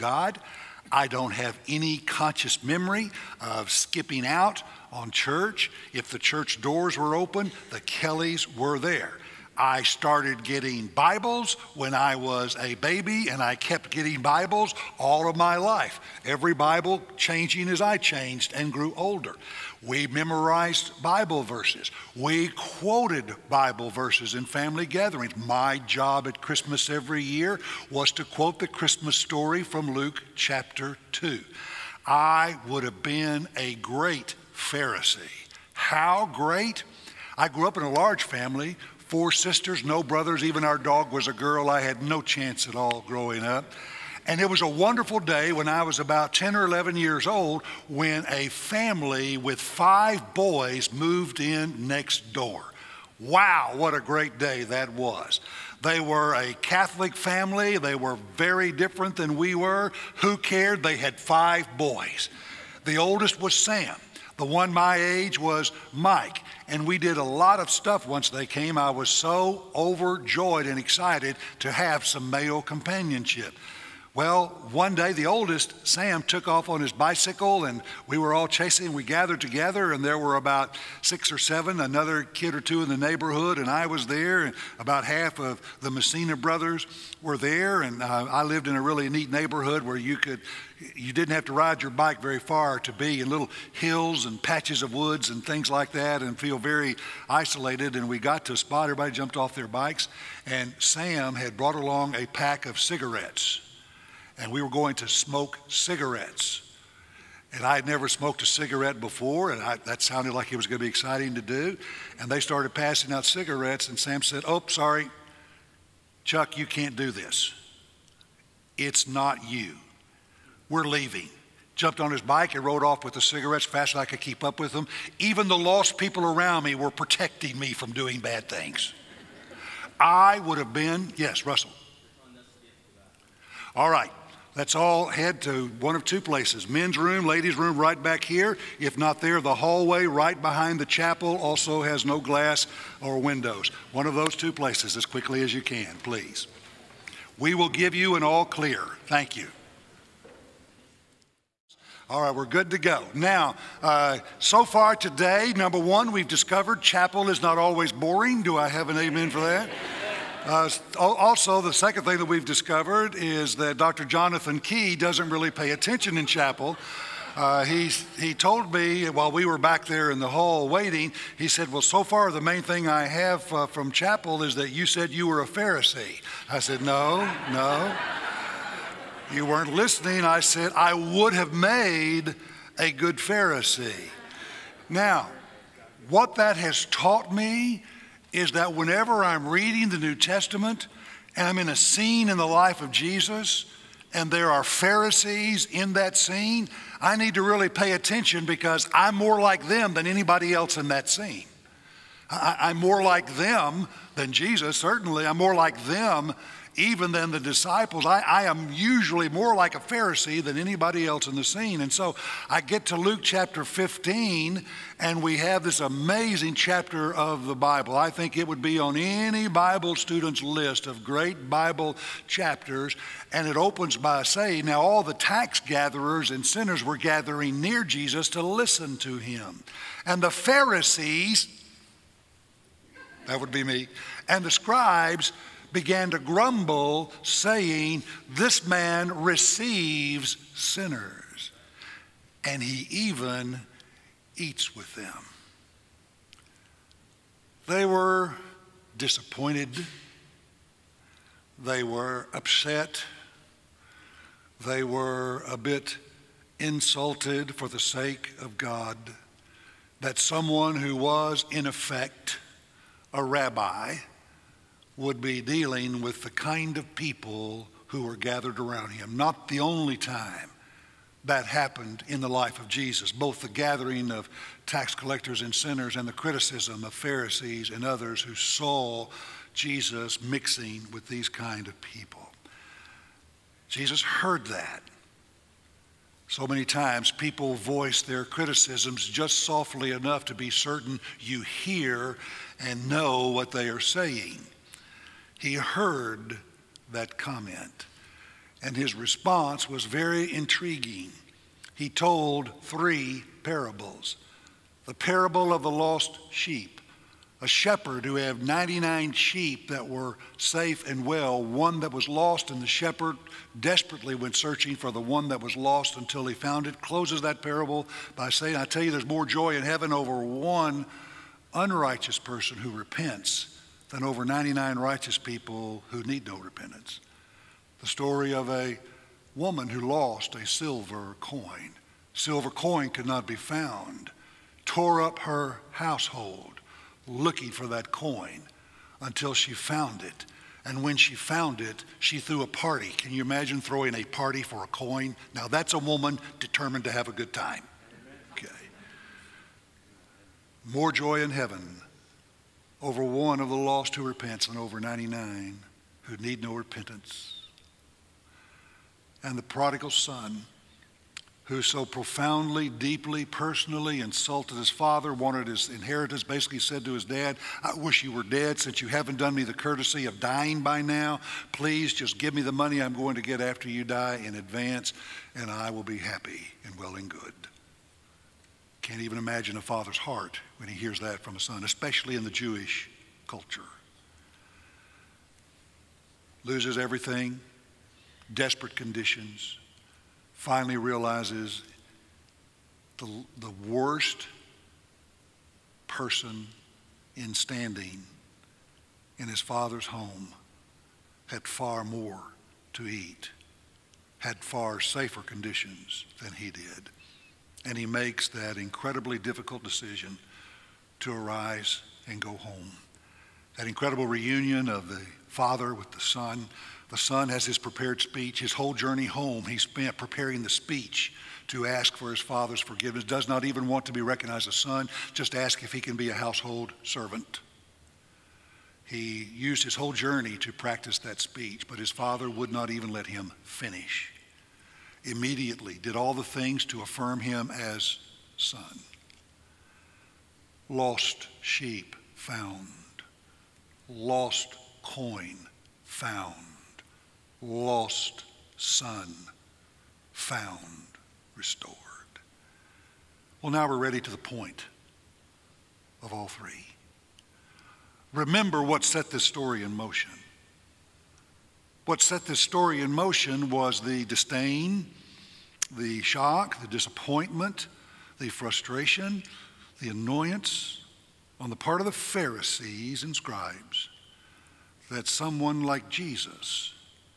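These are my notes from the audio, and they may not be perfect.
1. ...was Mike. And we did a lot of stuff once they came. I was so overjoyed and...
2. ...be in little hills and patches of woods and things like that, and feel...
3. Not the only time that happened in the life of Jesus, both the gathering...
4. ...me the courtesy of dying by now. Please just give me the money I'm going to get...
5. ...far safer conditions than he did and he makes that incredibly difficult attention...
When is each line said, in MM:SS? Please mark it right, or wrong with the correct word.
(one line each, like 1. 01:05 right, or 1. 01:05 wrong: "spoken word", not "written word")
1. 01:05 right
2. 01:32 right
3. 04:29 right
4. 06:09 right
5. 06:44 wrong: "decision", not "attention".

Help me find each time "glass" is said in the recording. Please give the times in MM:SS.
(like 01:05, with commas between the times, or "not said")
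02:22.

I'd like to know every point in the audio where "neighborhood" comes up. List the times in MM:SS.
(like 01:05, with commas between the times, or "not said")
01:22, 01:29.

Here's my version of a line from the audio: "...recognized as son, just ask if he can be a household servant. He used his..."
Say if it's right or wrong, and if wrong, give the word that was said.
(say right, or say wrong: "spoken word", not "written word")
right.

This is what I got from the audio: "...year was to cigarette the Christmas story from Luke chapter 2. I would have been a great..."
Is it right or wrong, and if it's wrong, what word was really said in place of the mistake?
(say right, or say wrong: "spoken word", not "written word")
wrong: "quote", not "cigarette".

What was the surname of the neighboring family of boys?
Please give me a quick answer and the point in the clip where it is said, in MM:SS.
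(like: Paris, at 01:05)
Messina, at 01:25.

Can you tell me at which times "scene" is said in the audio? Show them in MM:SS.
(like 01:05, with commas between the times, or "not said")
03:11, 03:16, 03:21, 03:31.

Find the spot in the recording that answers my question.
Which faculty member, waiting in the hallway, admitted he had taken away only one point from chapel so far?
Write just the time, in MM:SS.
02:43.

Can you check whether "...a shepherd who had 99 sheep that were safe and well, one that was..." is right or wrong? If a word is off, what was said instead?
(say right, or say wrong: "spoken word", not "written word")
right.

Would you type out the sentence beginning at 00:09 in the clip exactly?
I started getting Bibles when I was a baby, and I kept getting Bibles all of my life.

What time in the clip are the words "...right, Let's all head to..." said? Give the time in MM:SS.
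02:13.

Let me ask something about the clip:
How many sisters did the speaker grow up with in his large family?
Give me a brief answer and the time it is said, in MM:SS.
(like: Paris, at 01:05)
4, at 00:39.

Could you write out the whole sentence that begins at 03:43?
And it opens by saying, Now all the tax gatherers and sinners were gathering near Jesus to listen to him.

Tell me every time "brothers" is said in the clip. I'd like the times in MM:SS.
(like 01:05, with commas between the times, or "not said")
00:40, 01:26.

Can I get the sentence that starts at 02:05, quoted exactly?
Even the lost people around me were protecting me from doing bad things.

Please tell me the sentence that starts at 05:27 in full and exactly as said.
The story of a woman who lost a silver coin.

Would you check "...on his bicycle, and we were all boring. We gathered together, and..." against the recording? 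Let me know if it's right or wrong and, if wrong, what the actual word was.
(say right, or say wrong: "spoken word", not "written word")
wrong: "chasing", not "boring".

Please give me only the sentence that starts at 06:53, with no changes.
That incredible reunion of the father with the son.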